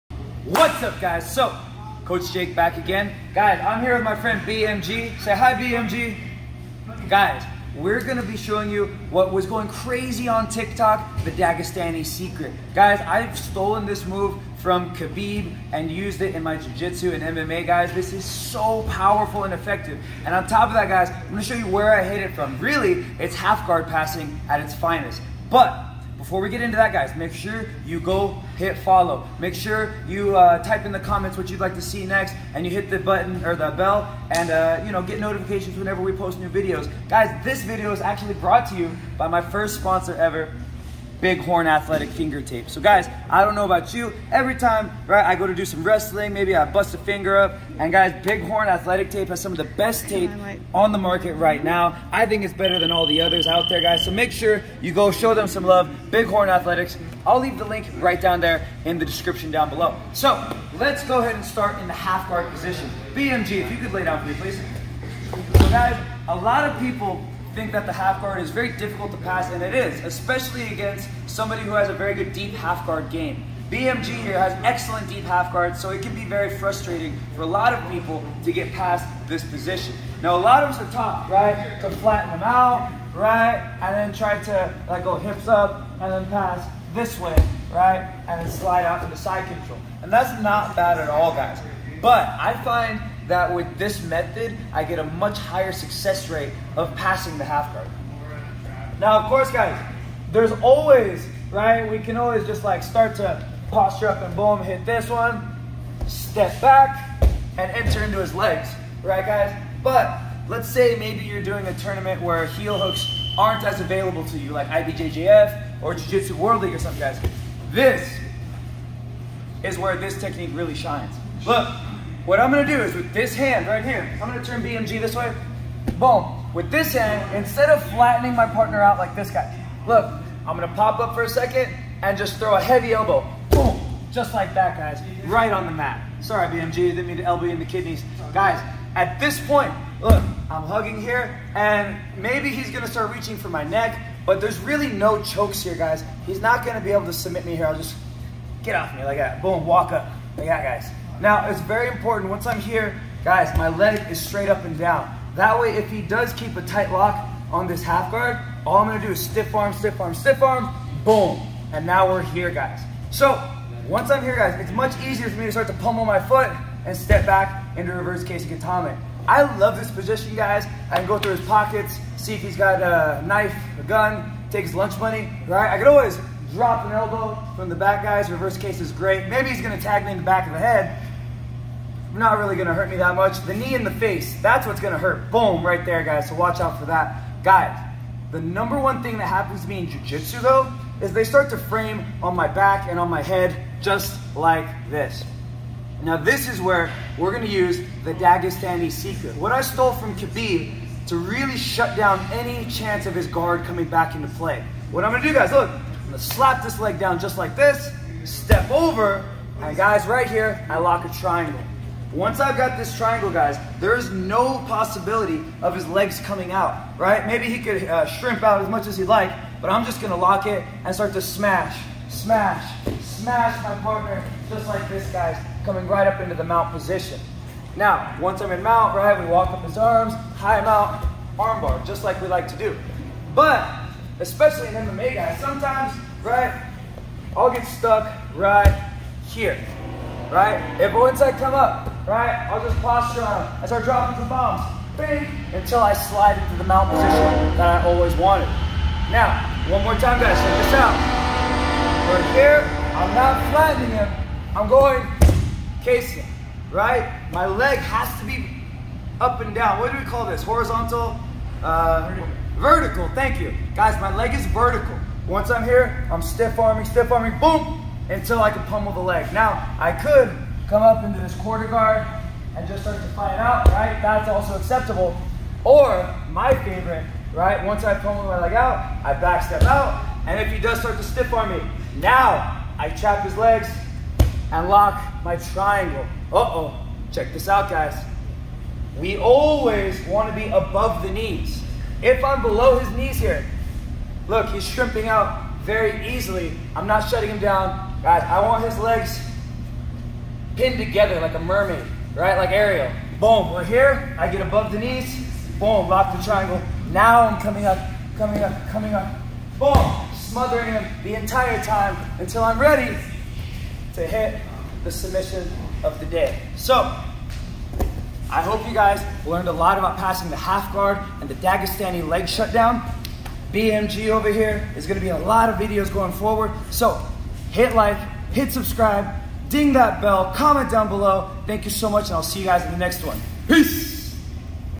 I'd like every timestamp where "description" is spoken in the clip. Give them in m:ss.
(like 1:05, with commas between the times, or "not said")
0:59.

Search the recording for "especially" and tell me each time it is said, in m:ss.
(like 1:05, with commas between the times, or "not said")
1:10, 3:54.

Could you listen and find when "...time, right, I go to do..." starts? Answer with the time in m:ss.
0:44.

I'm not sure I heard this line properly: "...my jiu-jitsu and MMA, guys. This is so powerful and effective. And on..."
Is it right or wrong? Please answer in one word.
right.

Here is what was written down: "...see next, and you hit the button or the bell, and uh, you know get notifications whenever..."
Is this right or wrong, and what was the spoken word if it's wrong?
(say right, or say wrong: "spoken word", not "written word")
right.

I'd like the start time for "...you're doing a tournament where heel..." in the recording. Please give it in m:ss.
1:51.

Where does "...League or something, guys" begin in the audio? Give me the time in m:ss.
1:56.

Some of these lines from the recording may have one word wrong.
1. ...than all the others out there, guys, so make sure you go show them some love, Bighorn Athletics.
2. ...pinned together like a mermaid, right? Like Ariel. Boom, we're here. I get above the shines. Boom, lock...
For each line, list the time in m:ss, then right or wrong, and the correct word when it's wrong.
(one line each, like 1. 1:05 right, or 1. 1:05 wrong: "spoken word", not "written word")
1. 0:52 right
2. 5:00 wrong: "knees", not "shines".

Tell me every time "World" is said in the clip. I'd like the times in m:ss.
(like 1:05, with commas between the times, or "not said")
1:56.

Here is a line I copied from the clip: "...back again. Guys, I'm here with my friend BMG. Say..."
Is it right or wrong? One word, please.
right.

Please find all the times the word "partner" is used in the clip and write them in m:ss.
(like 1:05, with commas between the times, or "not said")
2:08, 3:43.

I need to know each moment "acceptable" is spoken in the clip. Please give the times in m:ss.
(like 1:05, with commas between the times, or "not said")
4:34.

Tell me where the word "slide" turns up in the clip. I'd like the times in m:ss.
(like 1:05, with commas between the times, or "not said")
1:28, 4:05.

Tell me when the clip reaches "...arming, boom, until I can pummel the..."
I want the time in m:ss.
4:27.